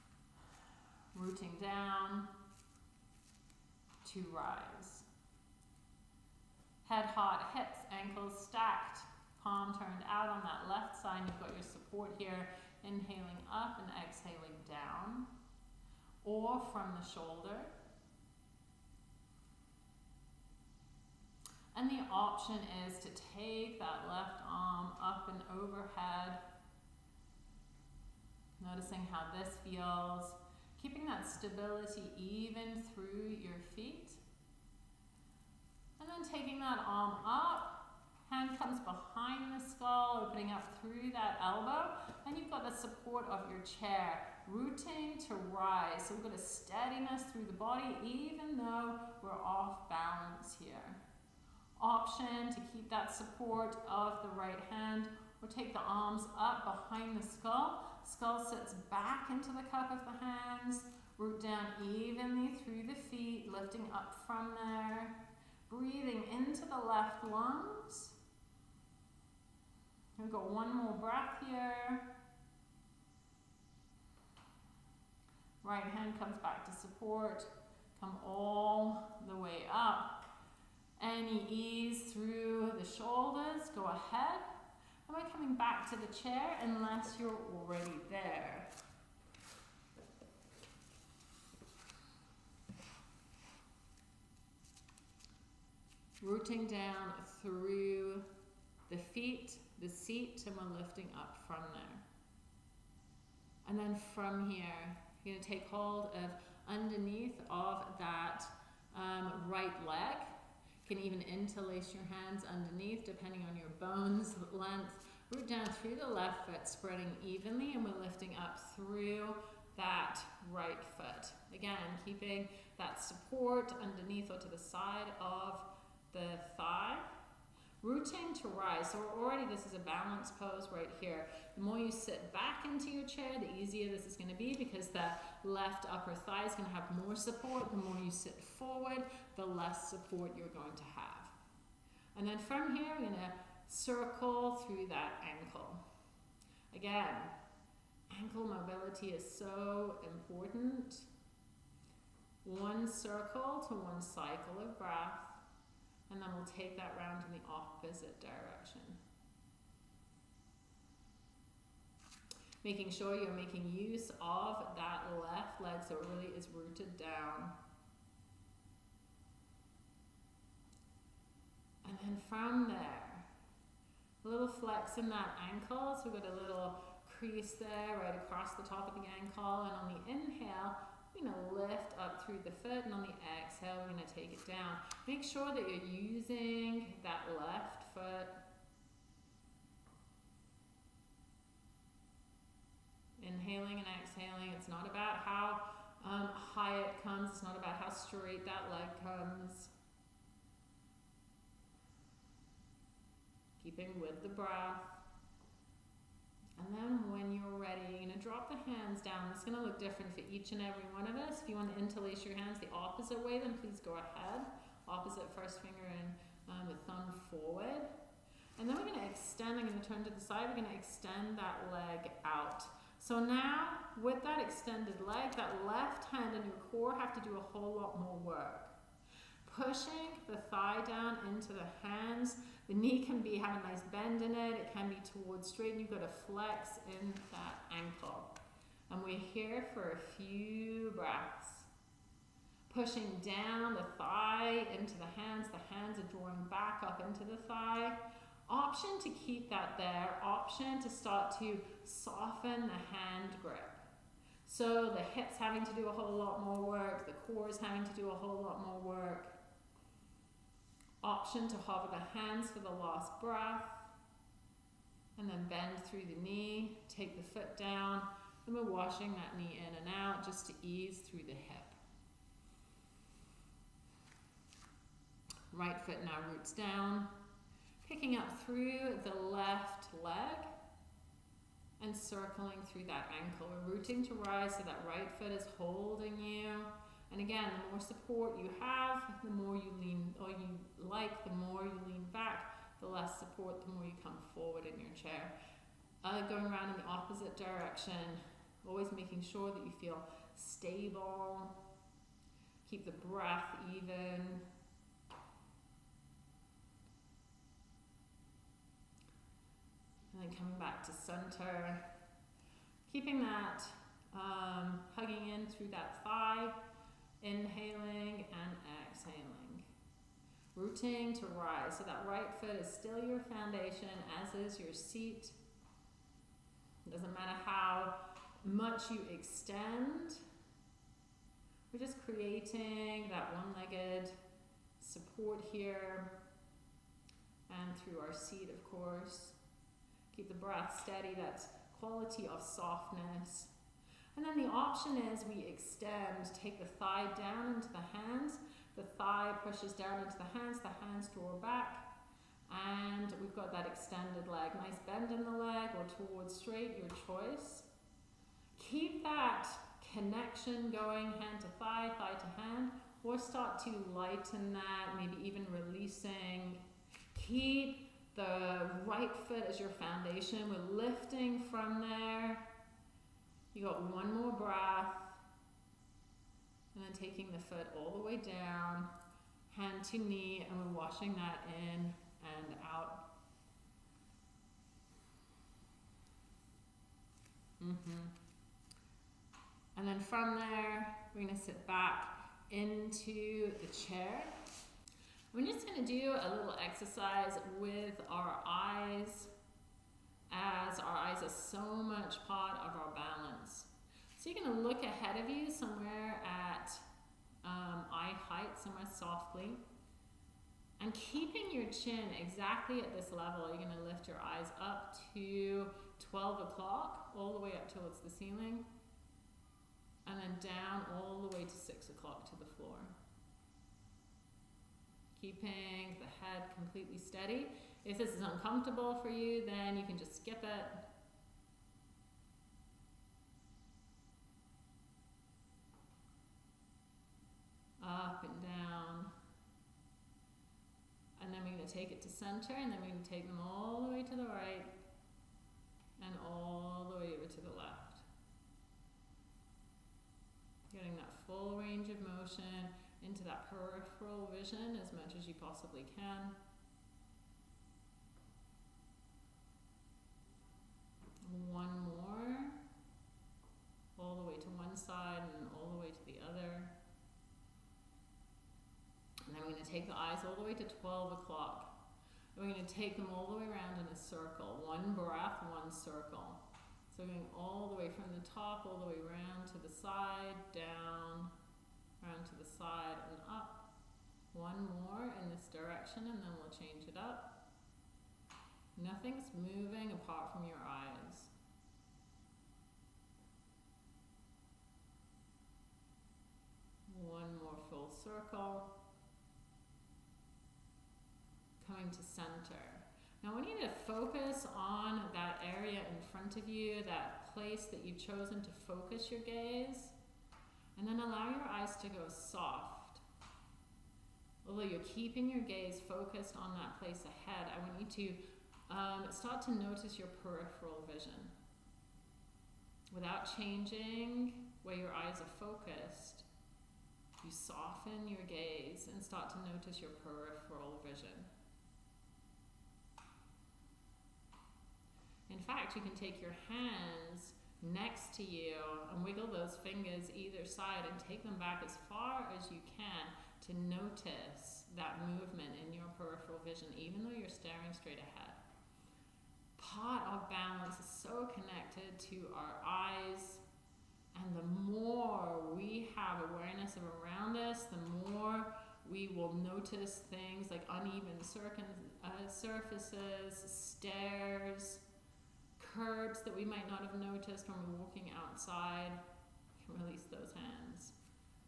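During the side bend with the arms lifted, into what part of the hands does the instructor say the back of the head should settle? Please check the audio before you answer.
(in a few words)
the cup of the hands.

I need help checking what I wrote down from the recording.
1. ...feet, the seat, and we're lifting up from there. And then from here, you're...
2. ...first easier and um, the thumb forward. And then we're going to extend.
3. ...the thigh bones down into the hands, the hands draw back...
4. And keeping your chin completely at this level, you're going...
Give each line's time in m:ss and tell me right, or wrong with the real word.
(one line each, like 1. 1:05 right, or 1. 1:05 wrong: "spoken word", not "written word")
1. 1:38 right
2. 3:35 wrong: "finger", not "easier"
3. 5:48 wrong: "pushes", not "bones"
4. 6:50 wrong: "exactly", not "completely".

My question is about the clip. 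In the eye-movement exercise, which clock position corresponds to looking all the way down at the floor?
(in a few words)
6 o'clock.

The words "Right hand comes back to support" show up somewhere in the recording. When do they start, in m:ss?
1:15.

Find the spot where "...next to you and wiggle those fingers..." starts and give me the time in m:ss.
8:57.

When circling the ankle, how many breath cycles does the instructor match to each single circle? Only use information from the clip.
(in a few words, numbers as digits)
1.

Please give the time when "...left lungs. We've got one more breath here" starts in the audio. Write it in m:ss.
1:06.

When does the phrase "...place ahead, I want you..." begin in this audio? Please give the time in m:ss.
8:36.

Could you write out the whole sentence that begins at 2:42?
Making sure you're making use of that left leg so it really is rooted down.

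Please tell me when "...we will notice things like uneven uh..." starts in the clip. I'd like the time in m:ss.
9:18.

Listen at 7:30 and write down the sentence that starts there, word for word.
Getting that full range of motion into that peripheral vision as much as you possibly can.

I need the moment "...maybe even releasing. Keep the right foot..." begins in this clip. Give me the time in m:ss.
6:04.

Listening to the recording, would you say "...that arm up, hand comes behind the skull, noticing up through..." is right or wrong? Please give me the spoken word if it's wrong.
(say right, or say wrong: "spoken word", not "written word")
wrong: "opening", not "noticing".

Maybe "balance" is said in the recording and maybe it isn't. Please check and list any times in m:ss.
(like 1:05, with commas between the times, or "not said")
0:49, 2:09, 6:42, 9:10.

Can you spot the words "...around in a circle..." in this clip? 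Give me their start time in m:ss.
7:53.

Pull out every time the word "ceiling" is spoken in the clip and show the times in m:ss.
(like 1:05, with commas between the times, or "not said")
6:58.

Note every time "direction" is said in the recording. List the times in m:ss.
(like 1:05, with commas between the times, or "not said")
2:38, 4:57, 8:05.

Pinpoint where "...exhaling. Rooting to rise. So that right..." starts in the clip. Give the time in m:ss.
5:18.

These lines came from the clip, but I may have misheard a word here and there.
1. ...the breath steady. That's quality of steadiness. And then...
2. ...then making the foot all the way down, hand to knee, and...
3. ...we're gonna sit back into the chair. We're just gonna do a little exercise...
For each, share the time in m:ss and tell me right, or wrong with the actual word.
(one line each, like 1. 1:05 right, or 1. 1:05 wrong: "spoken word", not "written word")
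1. 5:40 wrong: "softness", not "steadiness"
2. 6:16 wrong: "taking", not "making"
3. 6:31 right.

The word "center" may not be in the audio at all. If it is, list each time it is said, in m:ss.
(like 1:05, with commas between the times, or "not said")
5:11, 7:22, 8:21.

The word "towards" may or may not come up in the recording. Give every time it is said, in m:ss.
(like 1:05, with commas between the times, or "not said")
3:55, 5:56, 6:57.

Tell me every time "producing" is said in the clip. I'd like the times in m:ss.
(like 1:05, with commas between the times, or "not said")
not said.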